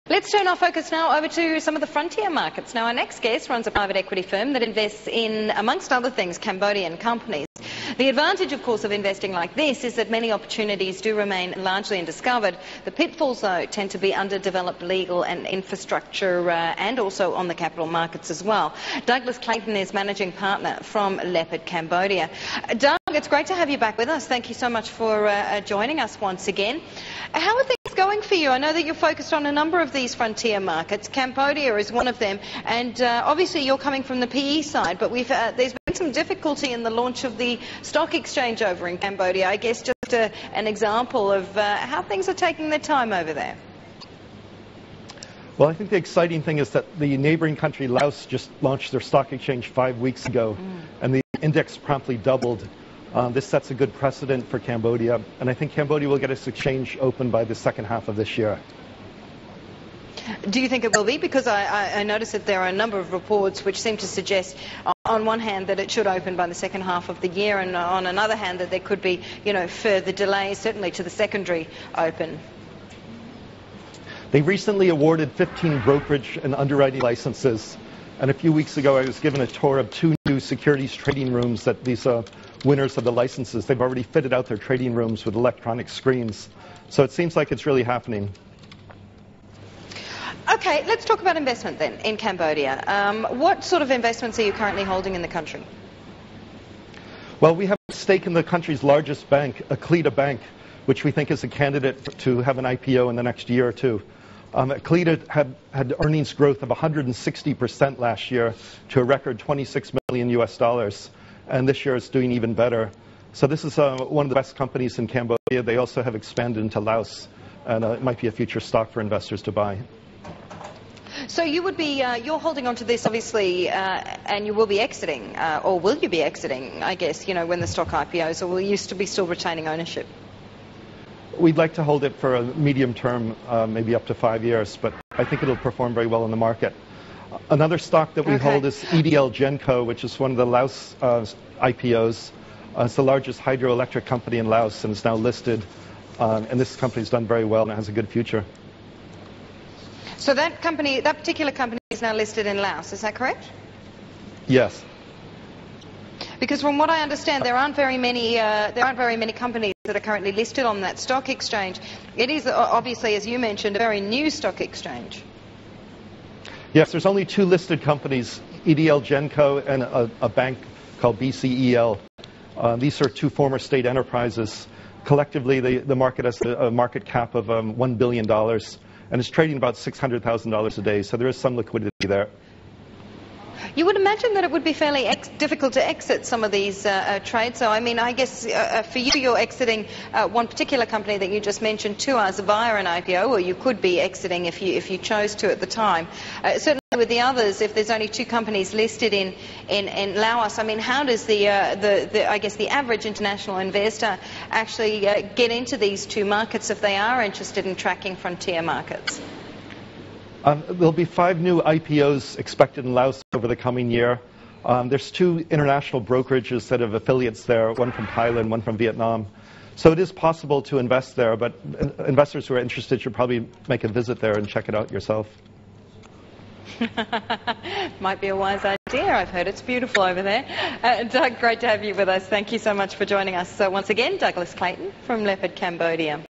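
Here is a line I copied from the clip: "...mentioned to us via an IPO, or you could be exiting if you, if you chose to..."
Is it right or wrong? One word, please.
right.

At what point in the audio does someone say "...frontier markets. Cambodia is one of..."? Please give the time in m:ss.
0:30.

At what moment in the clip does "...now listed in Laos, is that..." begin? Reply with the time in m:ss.
2:32.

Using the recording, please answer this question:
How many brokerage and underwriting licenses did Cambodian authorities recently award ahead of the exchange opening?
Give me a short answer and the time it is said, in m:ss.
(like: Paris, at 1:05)
15, at 1:15.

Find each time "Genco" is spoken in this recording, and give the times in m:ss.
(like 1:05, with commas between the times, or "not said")
2:19, 2:49.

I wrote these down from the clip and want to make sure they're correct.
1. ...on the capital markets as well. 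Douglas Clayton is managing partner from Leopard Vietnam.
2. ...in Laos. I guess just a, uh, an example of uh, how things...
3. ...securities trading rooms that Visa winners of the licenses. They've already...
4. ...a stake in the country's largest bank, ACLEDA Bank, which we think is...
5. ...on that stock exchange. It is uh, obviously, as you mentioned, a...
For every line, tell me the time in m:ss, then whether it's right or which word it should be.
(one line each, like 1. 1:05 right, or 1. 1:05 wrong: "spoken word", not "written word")
1. 0:17 wrong: "Cambodia", not "Vietnam"
2. 0:38 wrong: "Cambodia", not "Laos"
3. 1:20 right
4. 1:37 right
5. 2:40 right.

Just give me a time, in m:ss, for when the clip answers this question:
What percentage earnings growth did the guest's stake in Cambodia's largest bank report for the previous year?
1:46.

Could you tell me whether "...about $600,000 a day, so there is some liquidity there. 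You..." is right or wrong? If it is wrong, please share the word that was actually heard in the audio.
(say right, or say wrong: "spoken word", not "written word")
right.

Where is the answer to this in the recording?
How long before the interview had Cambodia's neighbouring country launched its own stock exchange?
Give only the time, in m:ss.
0:49.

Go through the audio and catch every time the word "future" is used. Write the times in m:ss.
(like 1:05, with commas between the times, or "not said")
1:58, 2:28.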